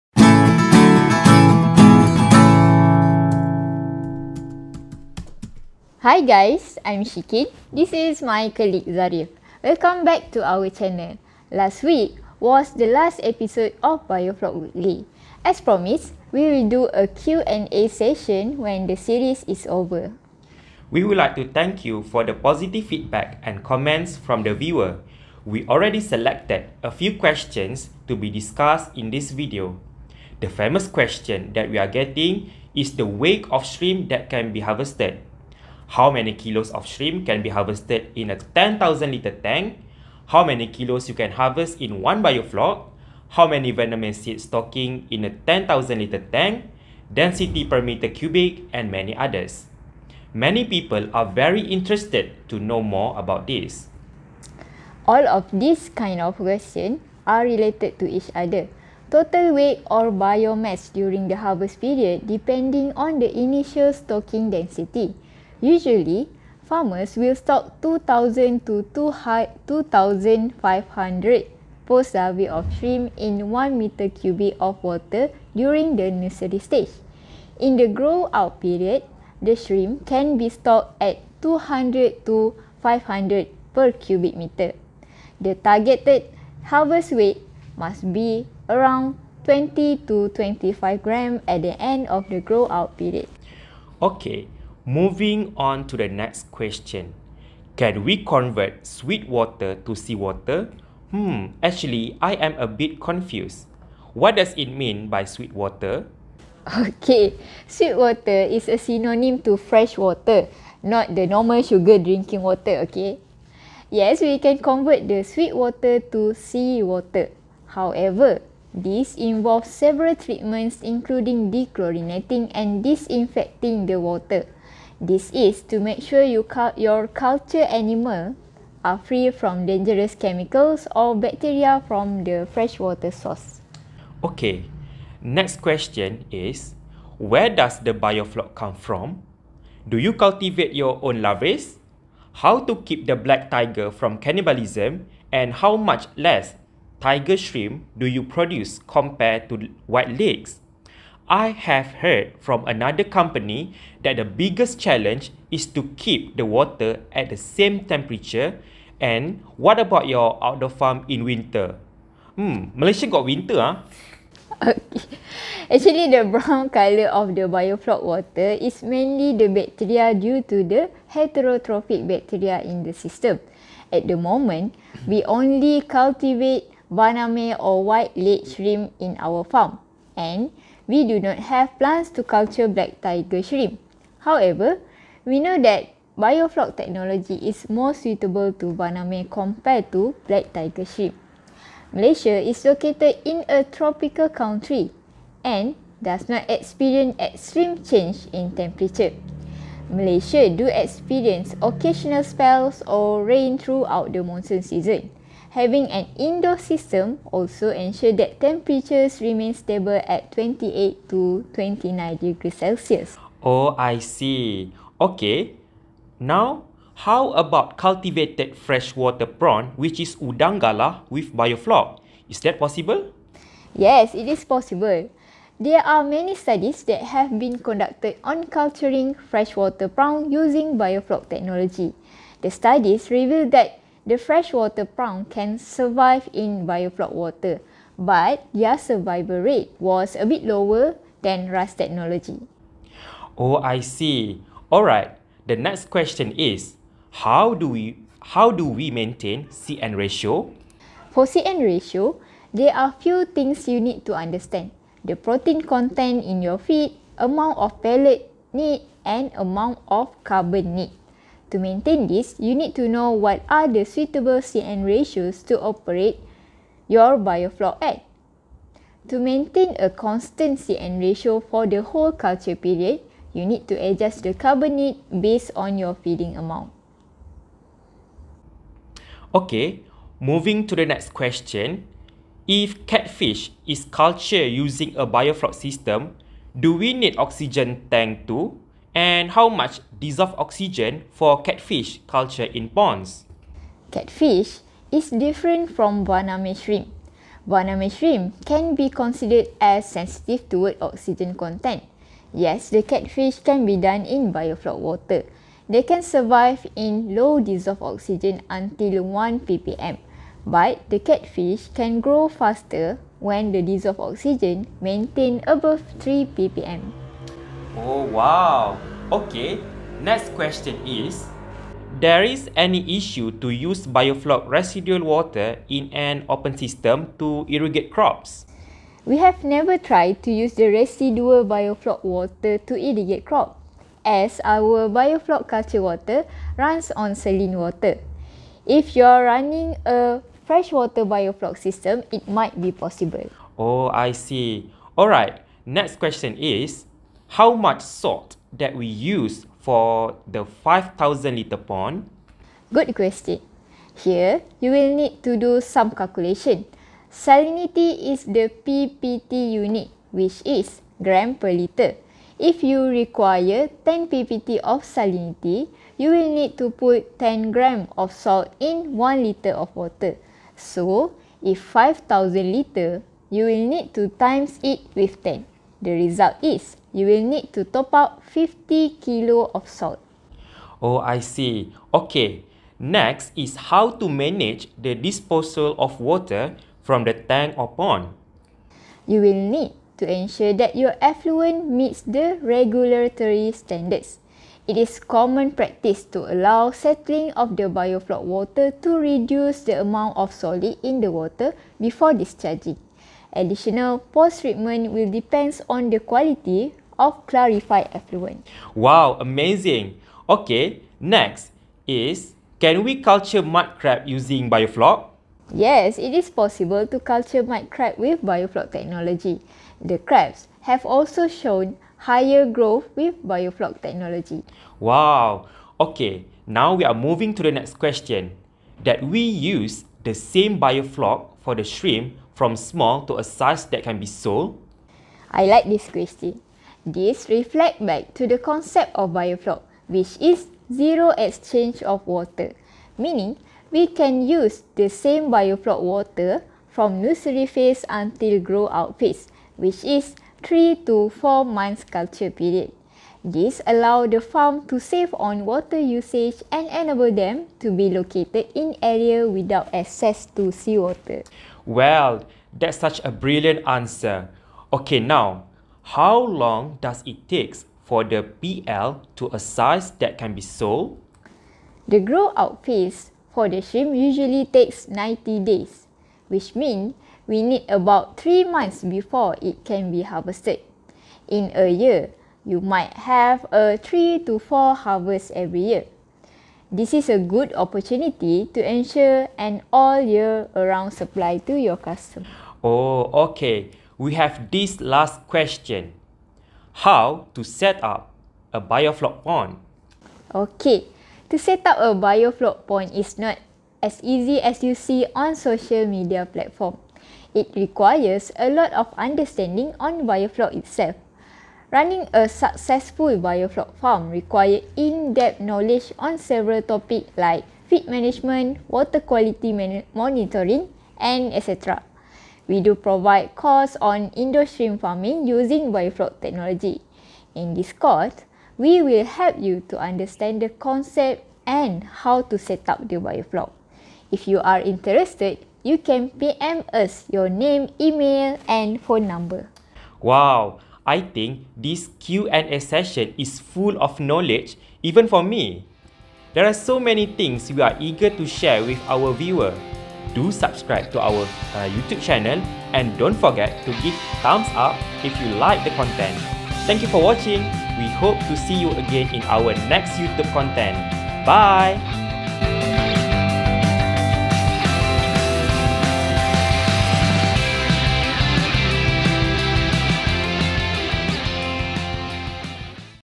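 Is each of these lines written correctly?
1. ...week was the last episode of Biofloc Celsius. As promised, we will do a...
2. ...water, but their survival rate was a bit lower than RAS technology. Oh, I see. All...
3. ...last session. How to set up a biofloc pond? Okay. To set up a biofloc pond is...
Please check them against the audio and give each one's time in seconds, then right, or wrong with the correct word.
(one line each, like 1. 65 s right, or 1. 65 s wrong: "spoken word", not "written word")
1. 11 s wrong: "Weekly", not "Celsius"
2. 237 s right
3. 494 s wrong: "question", not "session".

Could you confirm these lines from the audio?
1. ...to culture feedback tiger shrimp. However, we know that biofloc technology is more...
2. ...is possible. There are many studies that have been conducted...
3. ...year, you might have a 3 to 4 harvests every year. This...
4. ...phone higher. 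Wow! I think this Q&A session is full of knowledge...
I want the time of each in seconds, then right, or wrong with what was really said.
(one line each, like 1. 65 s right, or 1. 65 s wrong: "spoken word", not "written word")
1. 182 s wrong: "black", not "feedback"
2. 224 s right
3. 481 s right
4. 538 s wrong: "number", not "higher".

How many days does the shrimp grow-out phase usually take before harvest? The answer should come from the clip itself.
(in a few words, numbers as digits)
90 days.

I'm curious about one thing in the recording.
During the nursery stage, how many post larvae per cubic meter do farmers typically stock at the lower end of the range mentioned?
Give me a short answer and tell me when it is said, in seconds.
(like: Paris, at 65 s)
2,000, at 67 s.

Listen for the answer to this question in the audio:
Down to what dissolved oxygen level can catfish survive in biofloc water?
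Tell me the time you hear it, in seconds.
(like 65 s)
309 s.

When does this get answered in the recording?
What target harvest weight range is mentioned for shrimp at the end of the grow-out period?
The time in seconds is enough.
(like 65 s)
89 s.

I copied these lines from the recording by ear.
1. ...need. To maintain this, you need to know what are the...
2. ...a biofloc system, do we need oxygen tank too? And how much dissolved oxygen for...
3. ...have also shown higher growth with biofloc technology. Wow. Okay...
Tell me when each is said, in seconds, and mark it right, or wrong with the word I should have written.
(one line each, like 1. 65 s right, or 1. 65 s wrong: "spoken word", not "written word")
1. 260 s right
2. 284 s right
3. 420 s right.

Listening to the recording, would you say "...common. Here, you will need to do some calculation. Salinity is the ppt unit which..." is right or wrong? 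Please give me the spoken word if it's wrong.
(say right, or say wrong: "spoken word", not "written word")
wrong: "question", not "common".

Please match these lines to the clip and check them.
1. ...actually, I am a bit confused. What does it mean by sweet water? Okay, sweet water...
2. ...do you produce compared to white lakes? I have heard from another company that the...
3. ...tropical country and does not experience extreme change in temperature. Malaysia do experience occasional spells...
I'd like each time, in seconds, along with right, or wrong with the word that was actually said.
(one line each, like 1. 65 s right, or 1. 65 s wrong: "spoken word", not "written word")
1. 101 s right
2. 147 s right
3. 193 s right.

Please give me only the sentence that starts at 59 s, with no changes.
Total weight or biomass during the harvest period depending on the initial stocking density.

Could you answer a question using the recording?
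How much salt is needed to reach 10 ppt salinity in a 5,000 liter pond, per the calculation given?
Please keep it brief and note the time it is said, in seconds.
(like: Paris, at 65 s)
50 kilos, at 378 s.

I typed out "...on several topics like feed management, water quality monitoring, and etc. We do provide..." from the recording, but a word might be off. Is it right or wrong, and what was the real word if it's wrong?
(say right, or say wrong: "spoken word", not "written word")
right.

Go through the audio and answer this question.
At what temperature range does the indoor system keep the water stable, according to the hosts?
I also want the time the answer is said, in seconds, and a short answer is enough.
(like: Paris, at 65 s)
28 to 29 degrees Celsius, at 210 s.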